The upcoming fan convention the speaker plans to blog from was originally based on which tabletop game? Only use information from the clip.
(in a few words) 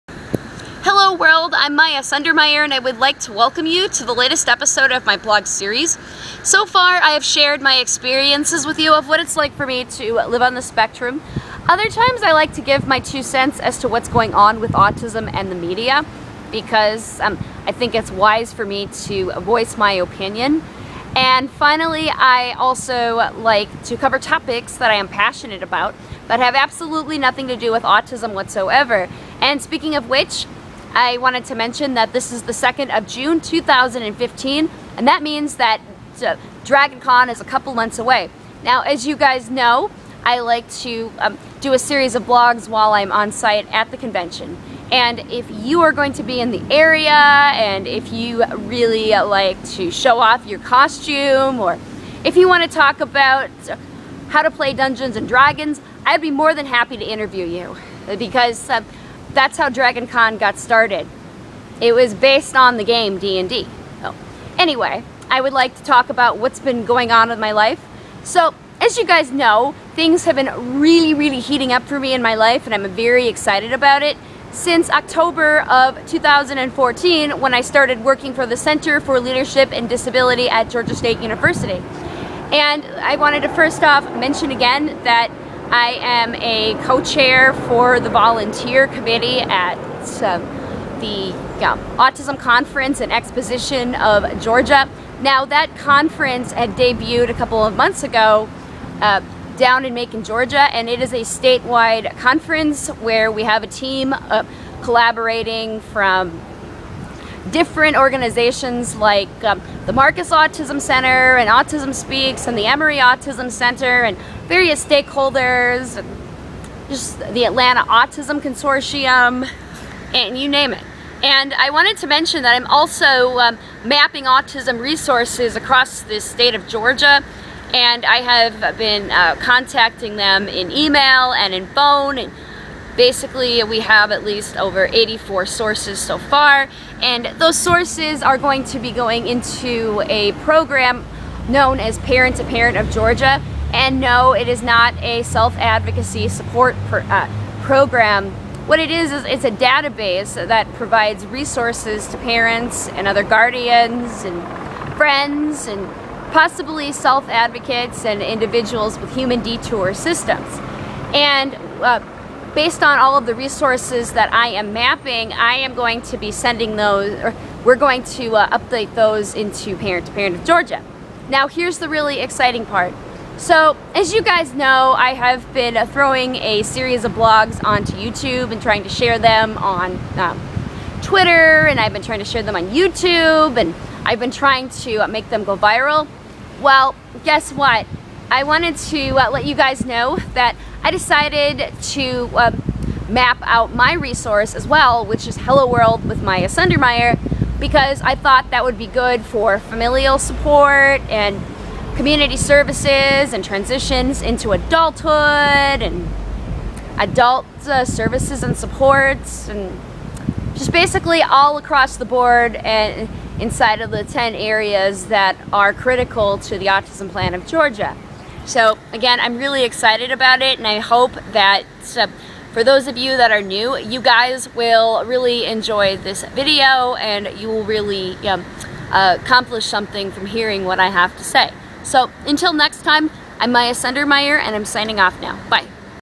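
Dungeons and Dragons.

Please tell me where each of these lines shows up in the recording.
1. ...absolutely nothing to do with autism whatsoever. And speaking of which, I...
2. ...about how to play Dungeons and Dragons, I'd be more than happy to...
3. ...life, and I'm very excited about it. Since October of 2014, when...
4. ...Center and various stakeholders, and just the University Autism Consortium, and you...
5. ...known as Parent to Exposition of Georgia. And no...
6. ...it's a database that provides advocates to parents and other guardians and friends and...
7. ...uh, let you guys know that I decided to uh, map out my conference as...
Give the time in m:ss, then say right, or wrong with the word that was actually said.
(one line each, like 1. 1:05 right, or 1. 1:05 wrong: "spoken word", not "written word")
1. 0:26 right
2. 0:52 right
3. 1:12 right
4. 1:53 wrong: "Atlanta", not "University"
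5. 2:21 wrong: "Parent", not "Exposition"
6. 2:29 wrong: "resources", not "advocates"
7. 3:09 wrong: "resource", not "conference".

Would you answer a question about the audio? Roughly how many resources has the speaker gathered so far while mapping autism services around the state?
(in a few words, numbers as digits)
84.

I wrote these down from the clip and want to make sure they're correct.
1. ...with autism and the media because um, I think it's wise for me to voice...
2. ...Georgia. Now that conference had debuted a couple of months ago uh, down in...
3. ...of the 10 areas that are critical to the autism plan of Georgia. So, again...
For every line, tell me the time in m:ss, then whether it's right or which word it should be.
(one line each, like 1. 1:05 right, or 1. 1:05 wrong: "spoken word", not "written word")
1. 0:14 right
2. 1:34 right
3. 3:33 right.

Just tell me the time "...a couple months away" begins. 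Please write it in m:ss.
0:37.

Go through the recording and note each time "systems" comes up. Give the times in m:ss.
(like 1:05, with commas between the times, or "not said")
2:39.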